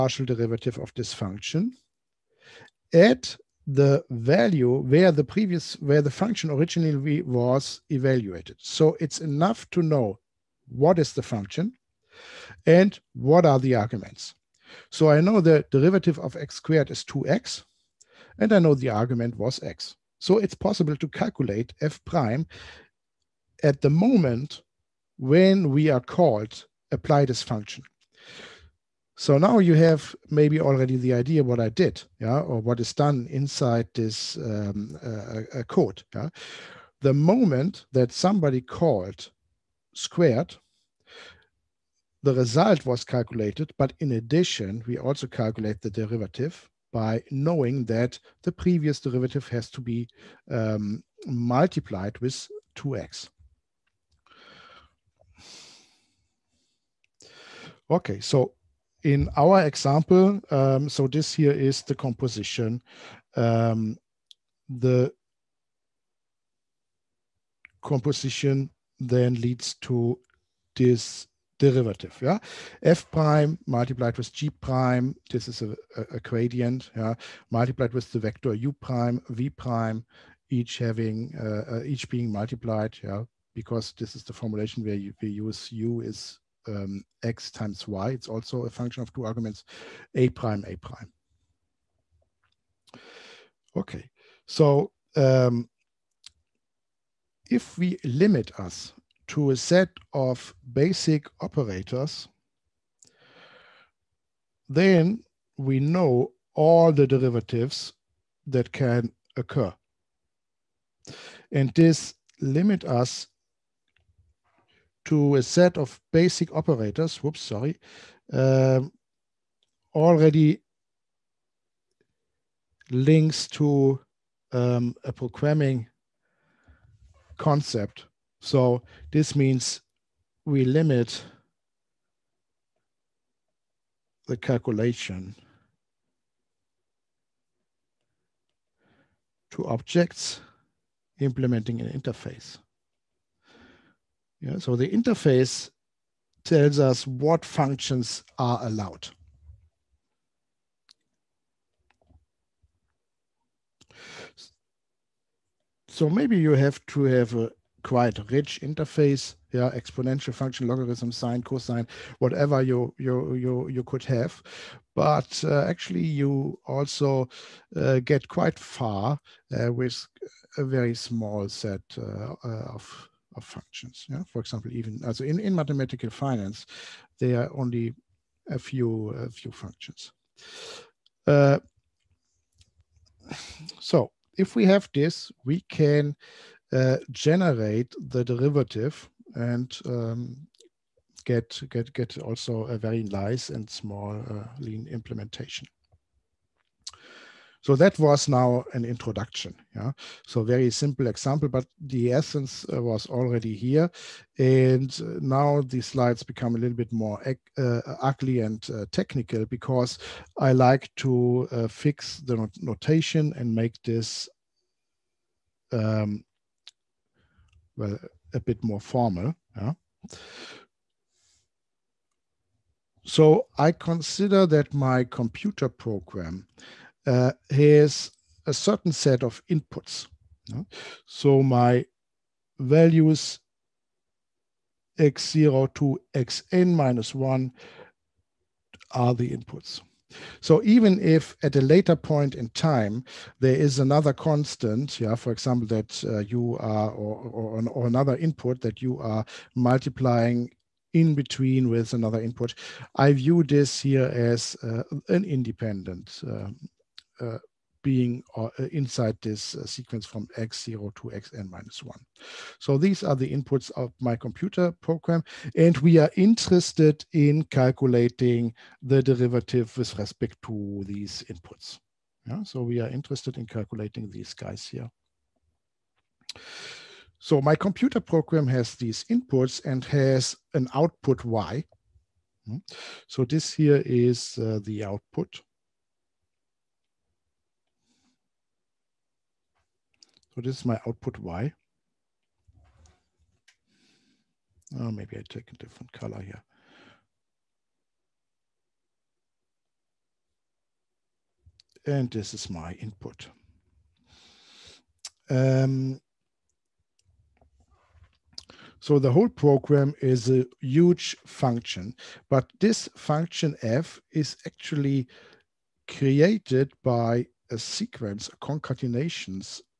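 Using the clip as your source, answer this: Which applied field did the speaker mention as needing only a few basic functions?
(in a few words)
mathematical finance.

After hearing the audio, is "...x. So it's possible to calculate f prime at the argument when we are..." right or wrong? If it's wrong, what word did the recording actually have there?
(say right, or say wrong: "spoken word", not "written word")
wrong: "moment", not "argument".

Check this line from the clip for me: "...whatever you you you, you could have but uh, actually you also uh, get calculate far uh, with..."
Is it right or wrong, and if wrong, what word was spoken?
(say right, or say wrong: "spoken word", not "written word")
wrong: "quite", not "calculate".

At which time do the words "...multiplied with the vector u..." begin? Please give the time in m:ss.
1:17.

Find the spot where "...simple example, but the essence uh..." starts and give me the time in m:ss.
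3:20.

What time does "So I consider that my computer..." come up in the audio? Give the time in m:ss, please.
3:43.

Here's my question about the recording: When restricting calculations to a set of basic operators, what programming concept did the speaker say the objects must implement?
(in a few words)
an interface.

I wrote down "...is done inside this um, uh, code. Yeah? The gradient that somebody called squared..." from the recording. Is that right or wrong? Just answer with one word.
wrong.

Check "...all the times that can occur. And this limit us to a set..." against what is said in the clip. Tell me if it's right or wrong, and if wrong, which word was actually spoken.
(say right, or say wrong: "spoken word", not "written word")
wrong: "derivatives", not "times".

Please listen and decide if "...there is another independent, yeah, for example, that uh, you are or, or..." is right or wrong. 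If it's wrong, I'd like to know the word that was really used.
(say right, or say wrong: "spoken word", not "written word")
wrong: "constant", not "independent".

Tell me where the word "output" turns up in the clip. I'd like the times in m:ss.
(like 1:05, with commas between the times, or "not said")
4:40, 4:44, 4:50.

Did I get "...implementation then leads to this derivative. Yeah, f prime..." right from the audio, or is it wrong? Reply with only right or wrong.
wrong.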